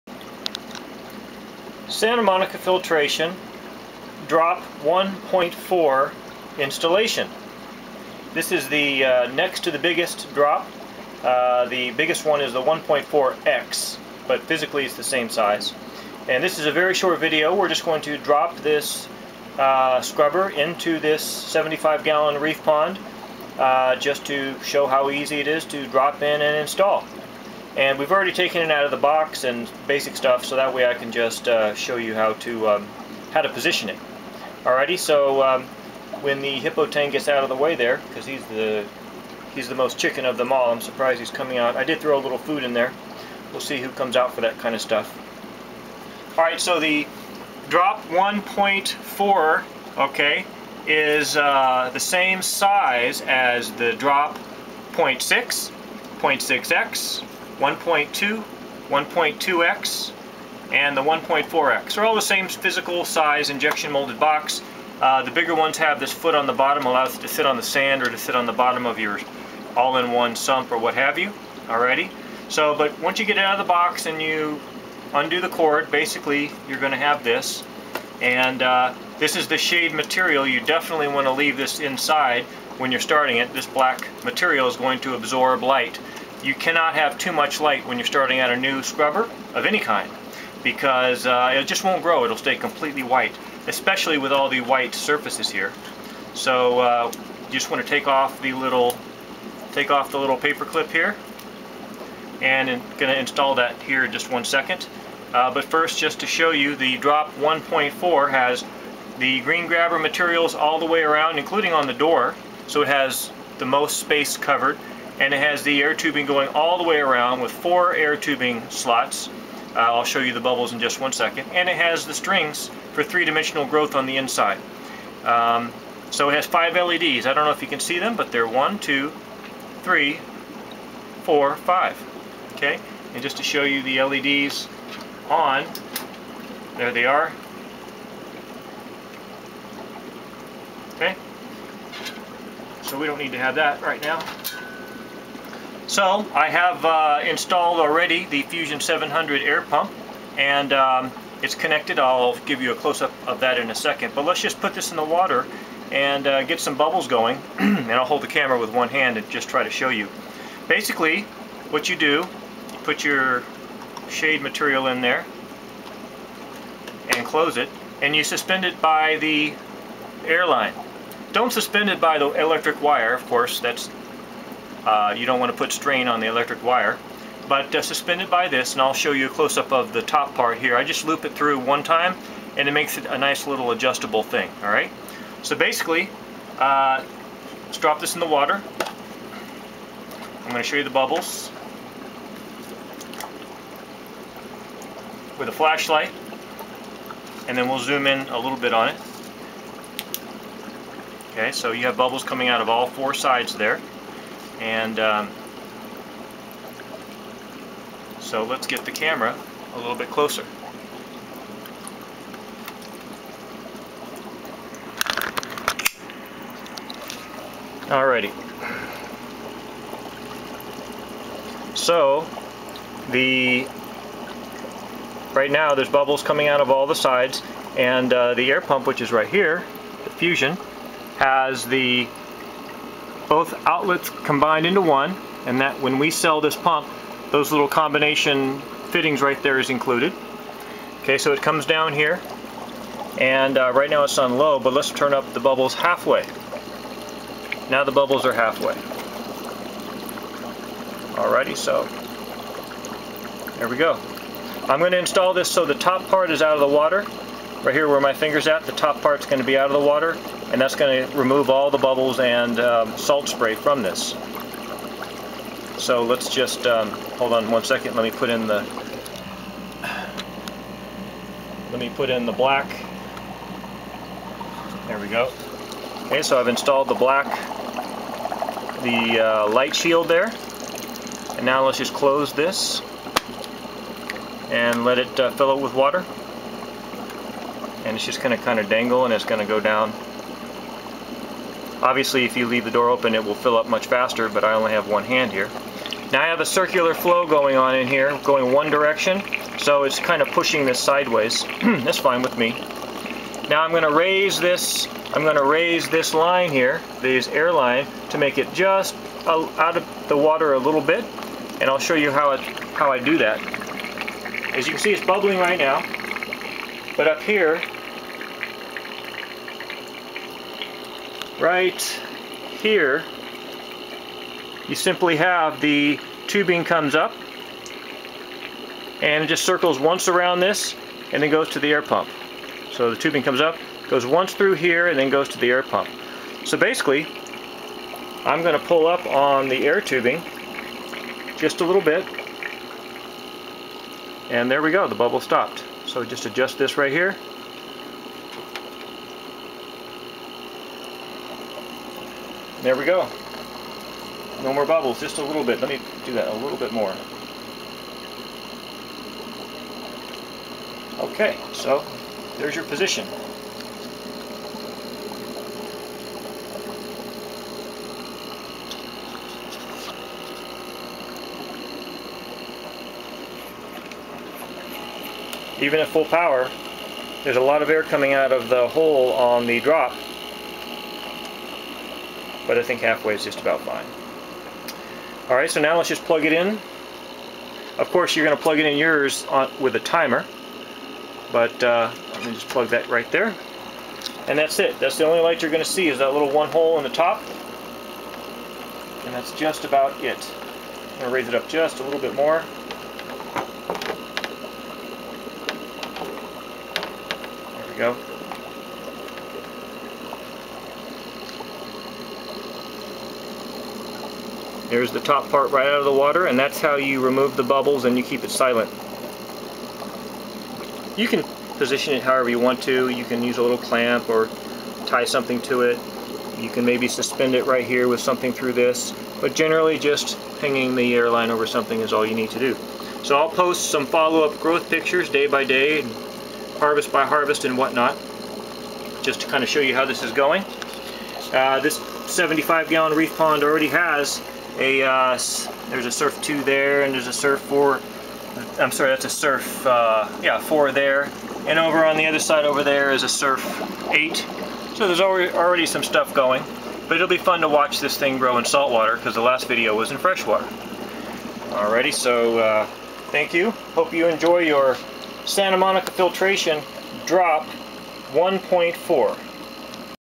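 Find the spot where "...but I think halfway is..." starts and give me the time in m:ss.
6:22.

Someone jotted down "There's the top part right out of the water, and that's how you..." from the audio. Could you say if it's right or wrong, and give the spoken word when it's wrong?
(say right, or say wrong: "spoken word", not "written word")
right.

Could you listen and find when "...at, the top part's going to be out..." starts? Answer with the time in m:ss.
4:18.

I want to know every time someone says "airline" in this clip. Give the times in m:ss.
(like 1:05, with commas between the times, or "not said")
2:50, 7:10.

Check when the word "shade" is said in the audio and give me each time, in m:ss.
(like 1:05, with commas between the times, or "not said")
1:19, 2:44.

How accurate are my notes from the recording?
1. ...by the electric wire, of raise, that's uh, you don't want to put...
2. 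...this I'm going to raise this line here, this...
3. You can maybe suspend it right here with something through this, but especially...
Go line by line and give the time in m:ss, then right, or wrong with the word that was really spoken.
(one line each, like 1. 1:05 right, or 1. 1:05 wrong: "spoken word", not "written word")
1. 2:51 wrong: "course", not "raise"
2. 5:04 right
3. 7:06 wrong: "generally", not "especially".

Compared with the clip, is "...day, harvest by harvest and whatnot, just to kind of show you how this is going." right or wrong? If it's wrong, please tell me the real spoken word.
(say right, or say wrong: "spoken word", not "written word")
right.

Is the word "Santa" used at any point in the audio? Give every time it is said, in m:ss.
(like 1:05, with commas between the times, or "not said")
0:01, 7:45.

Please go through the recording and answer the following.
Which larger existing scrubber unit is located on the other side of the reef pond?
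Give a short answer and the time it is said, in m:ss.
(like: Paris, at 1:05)
Surf 8, at 7:33.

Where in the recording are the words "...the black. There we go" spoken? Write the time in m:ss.
4:32.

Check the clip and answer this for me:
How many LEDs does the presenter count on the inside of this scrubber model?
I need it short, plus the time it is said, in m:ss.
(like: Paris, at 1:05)
5, at 2:06.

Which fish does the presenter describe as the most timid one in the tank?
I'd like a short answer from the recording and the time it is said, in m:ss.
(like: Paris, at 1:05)
Hippo tang, at 0:36.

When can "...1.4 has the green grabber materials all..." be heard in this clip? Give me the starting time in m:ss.
1:47.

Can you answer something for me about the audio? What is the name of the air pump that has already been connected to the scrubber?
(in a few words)
Fusion 700.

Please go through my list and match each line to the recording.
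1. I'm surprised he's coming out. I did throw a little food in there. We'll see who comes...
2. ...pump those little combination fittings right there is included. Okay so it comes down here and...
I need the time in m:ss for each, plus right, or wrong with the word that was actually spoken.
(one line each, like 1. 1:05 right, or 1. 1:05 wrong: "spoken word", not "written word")
1. 0:40 right
2. 3:56 right.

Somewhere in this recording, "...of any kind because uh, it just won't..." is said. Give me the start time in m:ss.
1:29.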